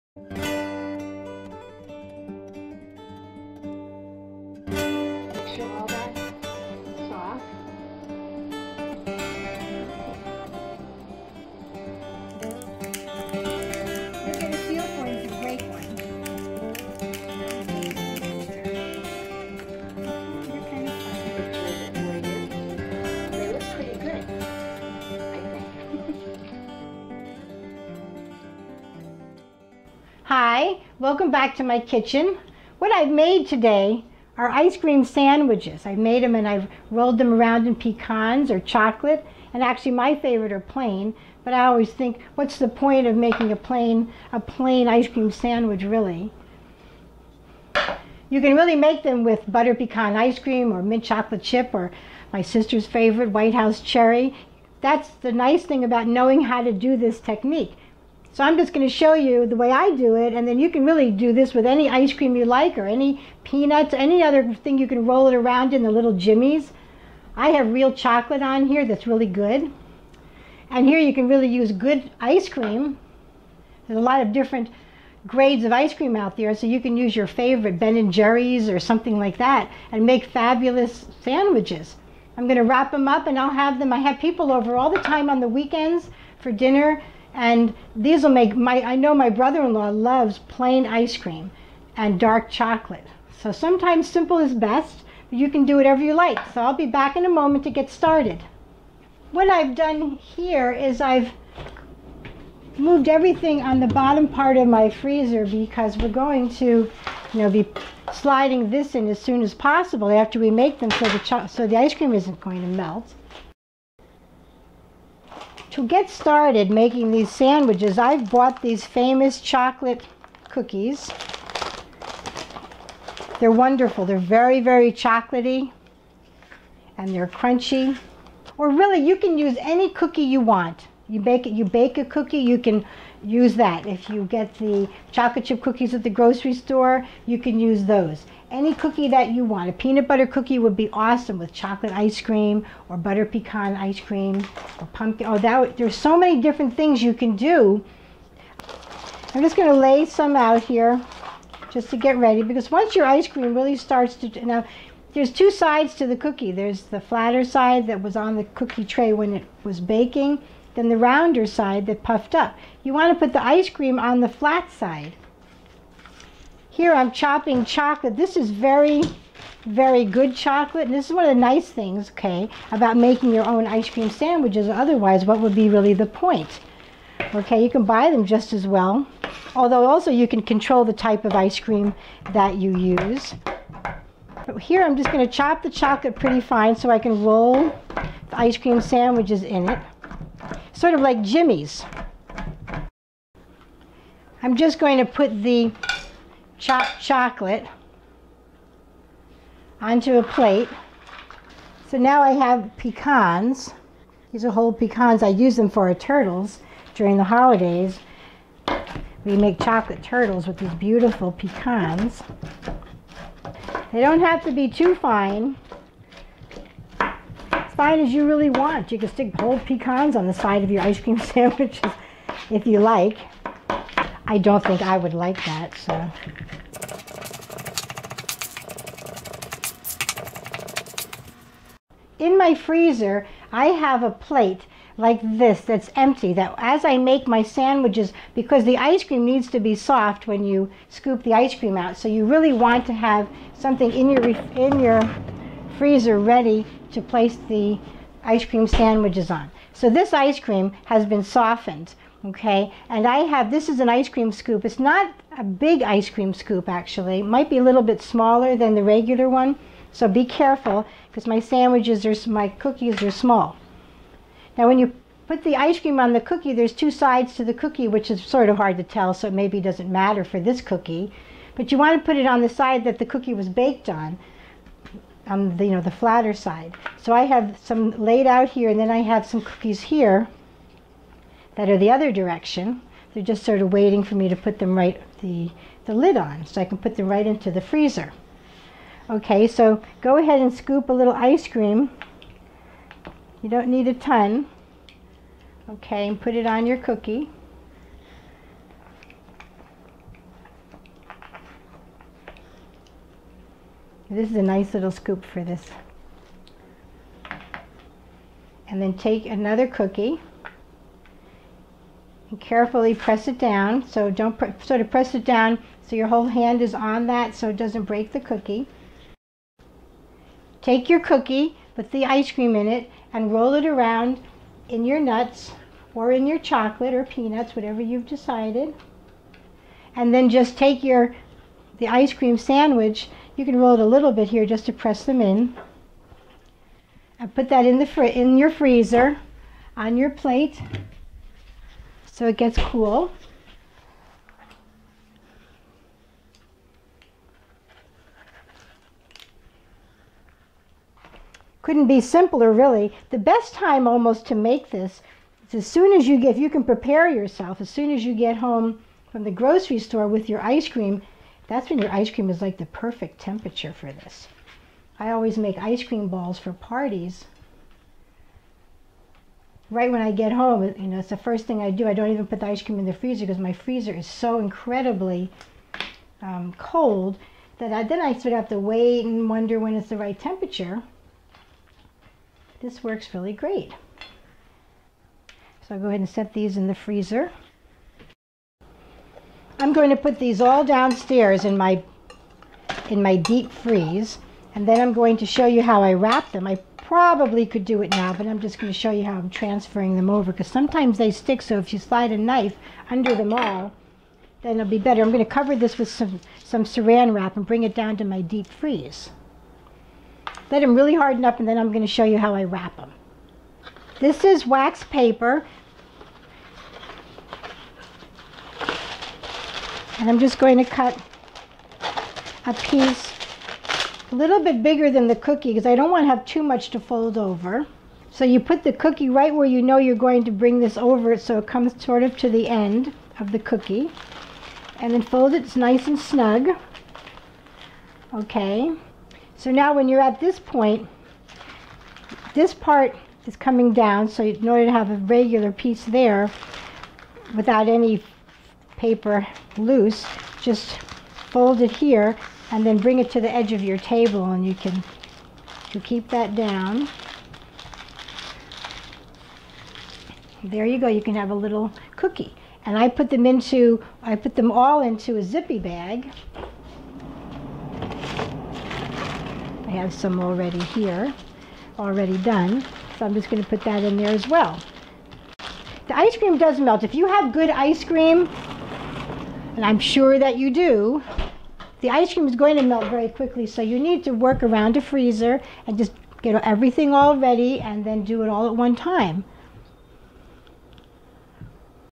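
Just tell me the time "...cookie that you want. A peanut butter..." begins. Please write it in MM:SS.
02:18.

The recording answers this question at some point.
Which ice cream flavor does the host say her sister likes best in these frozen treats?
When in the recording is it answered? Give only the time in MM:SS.
00:53.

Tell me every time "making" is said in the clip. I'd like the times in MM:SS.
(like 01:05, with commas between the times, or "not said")
00:43, 01:56, 02:52.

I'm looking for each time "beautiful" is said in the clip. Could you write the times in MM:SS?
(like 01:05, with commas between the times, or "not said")
03:30.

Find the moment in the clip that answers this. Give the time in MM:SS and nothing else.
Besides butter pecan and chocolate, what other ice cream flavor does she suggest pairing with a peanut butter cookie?
02:24.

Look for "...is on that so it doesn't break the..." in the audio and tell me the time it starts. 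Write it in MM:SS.
05:16.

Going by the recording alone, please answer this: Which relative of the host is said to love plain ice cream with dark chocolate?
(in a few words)
brother-in-law.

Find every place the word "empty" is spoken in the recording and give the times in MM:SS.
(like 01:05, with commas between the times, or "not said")
03:55.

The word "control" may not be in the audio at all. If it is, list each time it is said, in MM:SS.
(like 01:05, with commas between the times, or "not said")
03:00.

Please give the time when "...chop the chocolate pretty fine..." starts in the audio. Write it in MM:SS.
03:05.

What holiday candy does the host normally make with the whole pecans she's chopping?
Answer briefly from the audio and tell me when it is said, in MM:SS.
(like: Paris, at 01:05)
chocolate turtles, at 03:29.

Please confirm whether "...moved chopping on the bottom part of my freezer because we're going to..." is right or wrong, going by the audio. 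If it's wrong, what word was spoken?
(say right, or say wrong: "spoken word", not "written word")
wrong: "everything", not "chopping".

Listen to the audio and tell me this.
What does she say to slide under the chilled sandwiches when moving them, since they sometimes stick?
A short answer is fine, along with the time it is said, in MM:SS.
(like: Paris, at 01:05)
a knife, at 06:42.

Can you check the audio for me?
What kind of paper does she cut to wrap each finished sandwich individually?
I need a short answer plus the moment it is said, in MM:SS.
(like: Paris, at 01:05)
wax paper, at 06:54.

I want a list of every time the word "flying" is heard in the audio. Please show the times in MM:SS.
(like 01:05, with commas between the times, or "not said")
not said.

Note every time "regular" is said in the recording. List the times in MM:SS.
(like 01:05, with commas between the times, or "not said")
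04:18, 07:24.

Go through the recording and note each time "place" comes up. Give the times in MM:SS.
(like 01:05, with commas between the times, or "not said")
04:07.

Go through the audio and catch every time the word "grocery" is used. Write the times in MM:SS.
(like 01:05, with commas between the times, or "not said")
02:16, 05:59.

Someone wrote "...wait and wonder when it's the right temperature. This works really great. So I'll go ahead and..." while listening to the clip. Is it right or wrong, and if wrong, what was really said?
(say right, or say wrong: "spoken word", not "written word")
right.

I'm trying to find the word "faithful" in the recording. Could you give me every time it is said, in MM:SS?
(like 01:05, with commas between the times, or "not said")
not said.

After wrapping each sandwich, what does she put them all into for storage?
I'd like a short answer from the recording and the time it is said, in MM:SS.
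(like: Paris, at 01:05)
a zippy bag, at 07:45.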